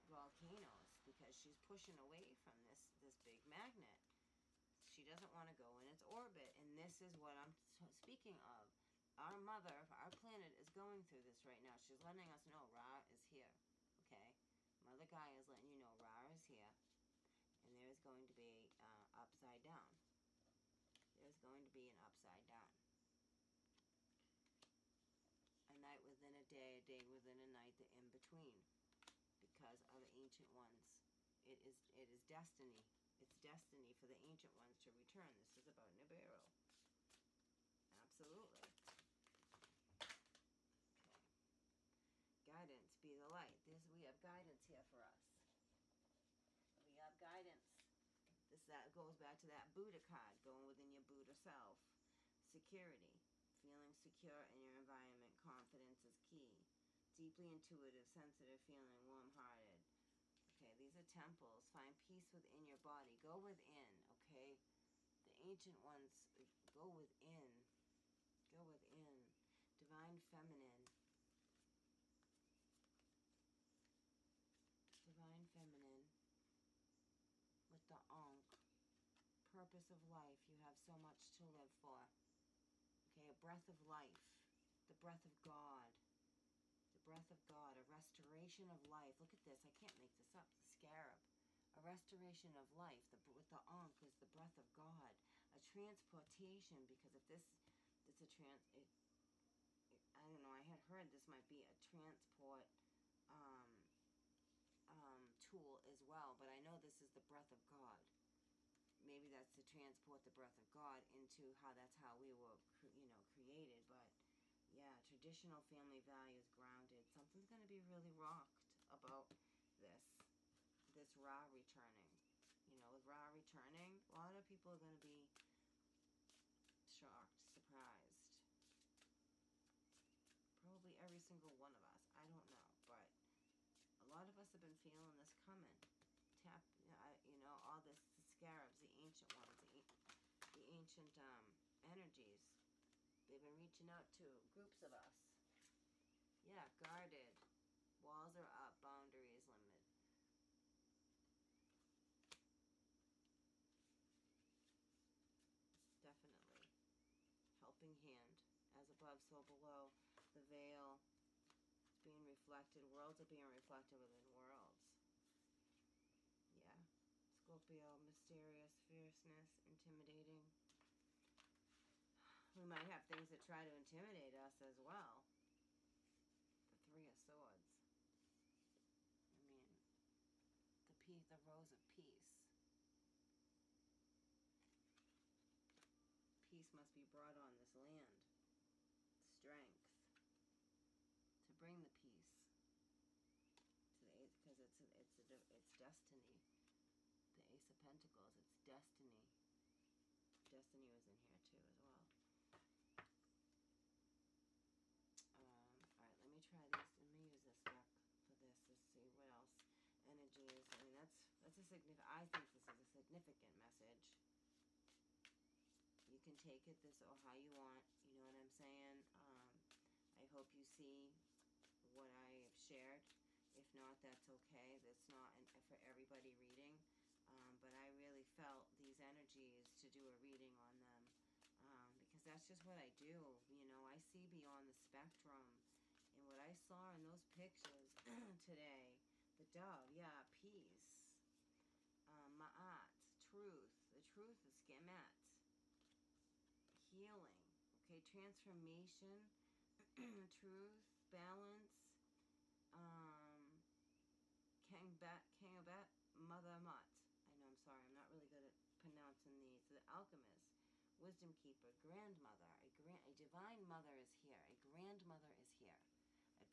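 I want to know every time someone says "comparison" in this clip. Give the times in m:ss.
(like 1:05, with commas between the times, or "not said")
not said.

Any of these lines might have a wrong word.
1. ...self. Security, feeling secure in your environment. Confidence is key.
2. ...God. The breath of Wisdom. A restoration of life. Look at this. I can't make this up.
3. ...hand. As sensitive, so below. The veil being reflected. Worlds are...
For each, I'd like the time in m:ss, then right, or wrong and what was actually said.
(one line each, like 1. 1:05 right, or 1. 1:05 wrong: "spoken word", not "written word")
1. 0:51 right
2. 1:25 wrong: "God", not "Wisdom"
3. 2:37 wrong: "above", not "sensitive".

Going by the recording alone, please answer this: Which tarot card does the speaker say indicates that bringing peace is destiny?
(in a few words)
Ace of Pentacles.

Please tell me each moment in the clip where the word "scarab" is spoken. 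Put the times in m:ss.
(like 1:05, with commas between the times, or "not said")
1:30, 2:18.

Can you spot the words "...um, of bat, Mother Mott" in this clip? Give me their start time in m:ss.
4:12.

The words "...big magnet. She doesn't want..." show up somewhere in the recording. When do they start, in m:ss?
0:03.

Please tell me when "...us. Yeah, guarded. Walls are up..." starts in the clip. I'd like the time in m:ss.
2:24.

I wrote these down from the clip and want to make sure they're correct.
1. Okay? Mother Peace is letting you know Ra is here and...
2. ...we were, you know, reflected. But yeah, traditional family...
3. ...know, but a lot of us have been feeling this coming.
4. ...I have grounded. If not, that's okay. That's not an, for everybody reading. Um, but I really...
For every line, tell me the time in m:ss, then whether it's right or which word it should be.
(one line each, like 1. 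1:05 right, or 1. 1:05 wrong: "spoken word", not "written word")
1. 0:13 wrong: "Gaia", not "Peace"
2. 1:52 wrong: "created", not "reflected"
3. 2:12 right
4. 3:42 wrong: "shared", not "grounded".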